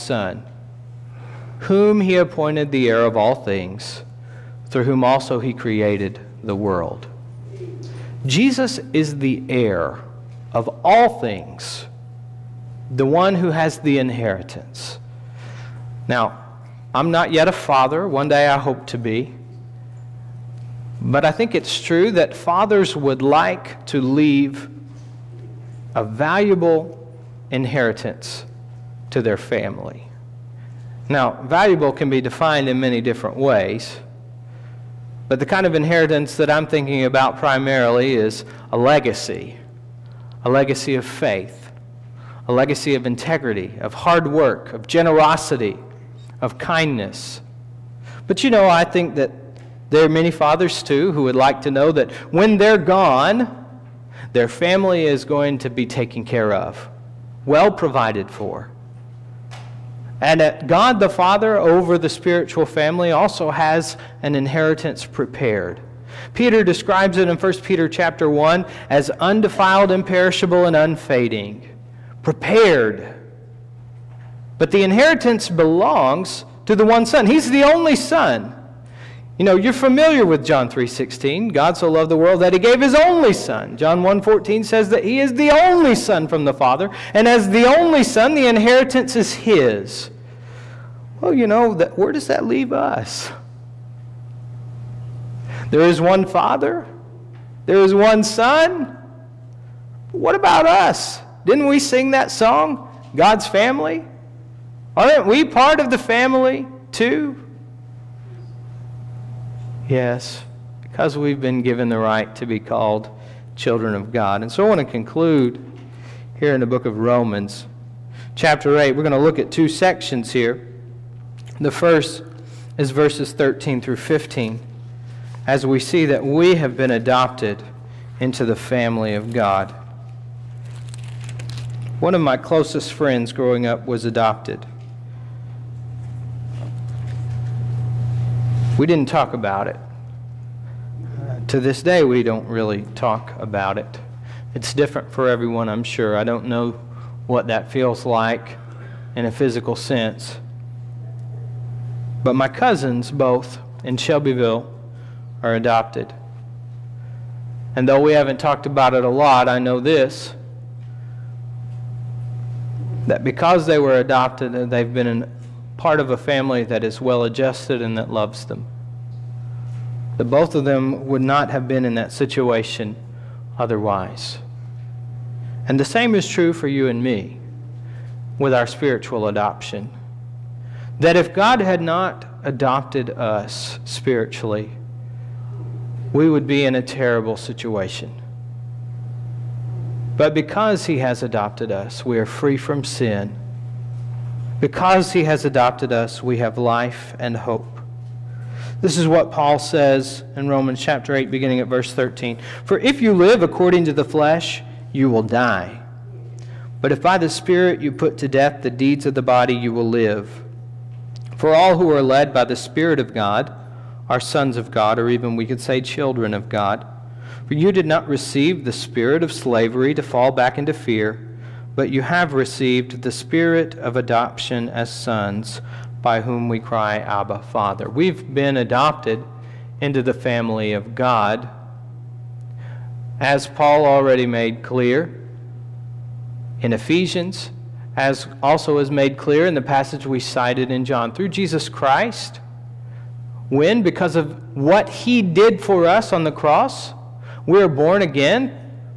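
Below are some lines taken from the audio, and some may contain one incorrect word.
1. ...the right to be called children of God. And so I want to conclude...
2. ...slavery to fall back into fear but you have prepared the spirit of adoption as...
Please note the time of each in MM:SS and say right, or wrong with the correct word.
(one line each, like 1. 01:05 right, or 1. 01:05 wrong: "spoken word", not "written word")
1. 01:51 right
2. 03:39 wrong: "received", not "prepared".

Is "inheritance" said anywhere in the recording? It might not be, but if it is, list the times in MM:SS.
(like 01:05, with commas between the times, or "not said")
00:13, 00:27, 00:35, 01:04, 01:14, 01:28.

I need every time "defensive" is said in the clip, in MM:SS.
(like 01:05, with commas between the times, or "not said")
not said.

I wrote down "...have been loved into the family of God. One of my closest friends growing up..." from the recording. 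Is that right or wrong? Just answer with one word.
wrong.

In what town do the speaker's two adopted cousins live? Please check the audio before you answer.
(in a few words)
Shelbyville.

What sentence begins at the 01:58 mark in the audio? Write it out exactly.
We're going to look at two sections here.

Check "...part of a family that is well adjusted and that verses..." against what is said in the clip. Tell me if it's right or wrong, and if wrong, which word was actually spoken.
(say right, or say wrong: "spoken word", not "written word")
wrong: "loves", not "verses".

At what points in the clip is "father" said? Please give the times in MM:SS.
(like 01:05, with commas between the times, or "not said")
00:17, 00:22, 00:50, 01:01, 01:26, 01:36, 03:47.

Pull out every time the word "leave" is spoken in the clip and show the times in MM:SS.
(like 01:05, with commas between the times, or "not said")
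00:24, 01:32.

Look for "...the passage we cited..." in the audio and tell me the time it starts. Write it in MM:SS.
03:59.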